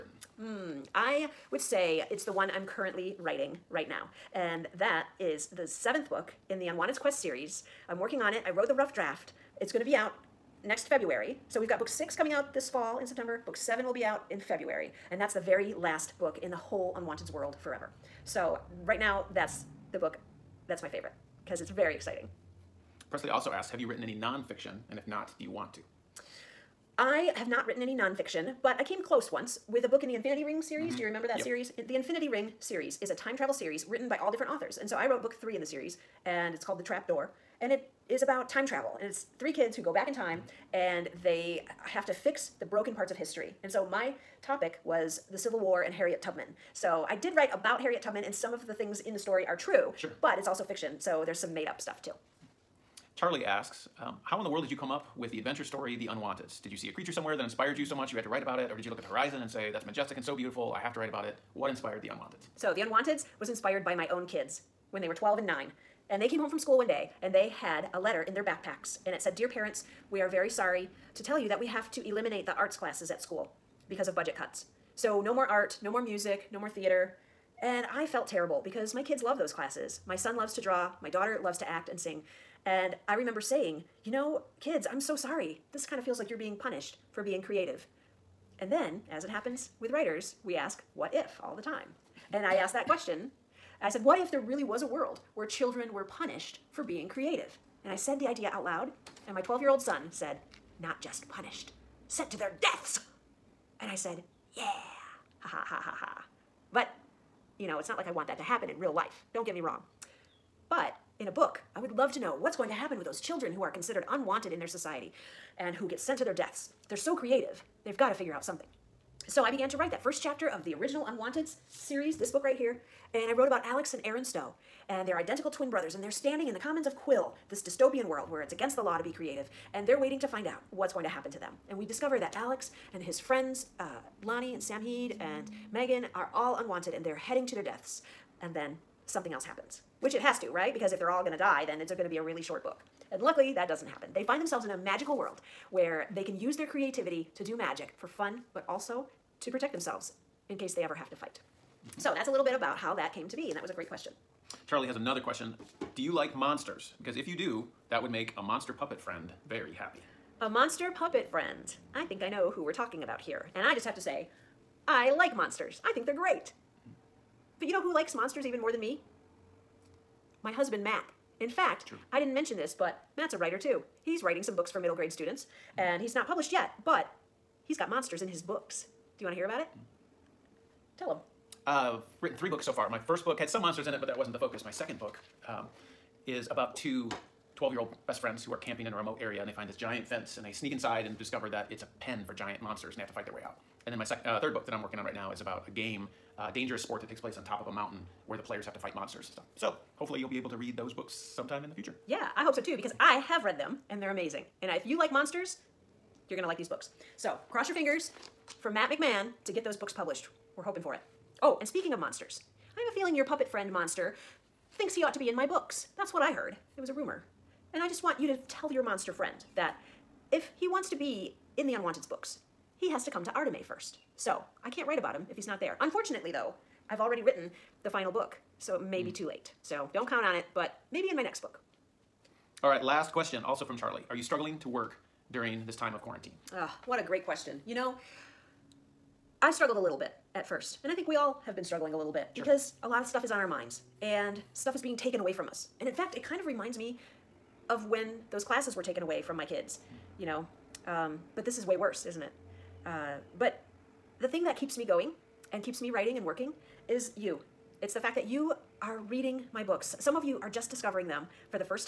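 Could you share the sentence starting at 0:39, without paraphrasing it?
And it's three kids who go back in time mm -hmm.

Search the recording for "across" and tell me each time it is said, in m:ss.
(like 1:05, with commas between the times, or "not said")
not said.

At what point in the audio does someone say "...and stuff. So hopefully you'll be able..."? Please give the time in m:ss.
3:19.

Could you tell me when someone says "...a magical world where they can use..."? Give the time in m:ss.
2:24.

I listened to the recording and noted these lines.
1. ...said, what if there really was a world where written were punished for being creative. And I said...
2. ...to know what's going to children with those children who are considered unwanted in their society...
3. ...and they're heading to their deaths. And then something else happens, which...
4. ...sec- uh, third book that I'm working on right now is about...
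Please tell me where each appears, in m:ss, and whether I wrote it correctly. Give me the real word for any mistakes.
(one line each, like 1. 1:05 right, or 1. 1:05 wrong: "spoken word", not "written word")
1. 1:33 wrong: "children", not "written"
2. 1:52 wrong: "happen", not "children"
3. 2:16 right
4. 3:14 right.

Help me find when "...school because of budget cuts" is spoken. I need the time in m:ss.
1:13.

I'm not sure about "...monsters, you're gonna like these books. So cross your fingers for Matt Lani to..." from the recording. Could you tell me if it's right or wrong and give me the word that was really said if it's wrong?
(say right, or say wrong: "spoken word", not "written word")
wrong: "McMann", not "Lani".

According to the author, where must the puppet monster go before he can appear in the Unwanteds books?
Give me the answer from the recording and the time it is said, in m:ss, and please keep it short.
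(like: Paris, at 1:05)
Artimé, at 3:43.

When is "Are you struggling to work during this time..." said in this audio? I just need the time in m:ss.
3:54.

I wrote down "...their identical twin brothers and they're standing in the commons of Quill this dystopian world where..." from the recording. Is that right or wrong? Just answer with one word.
right.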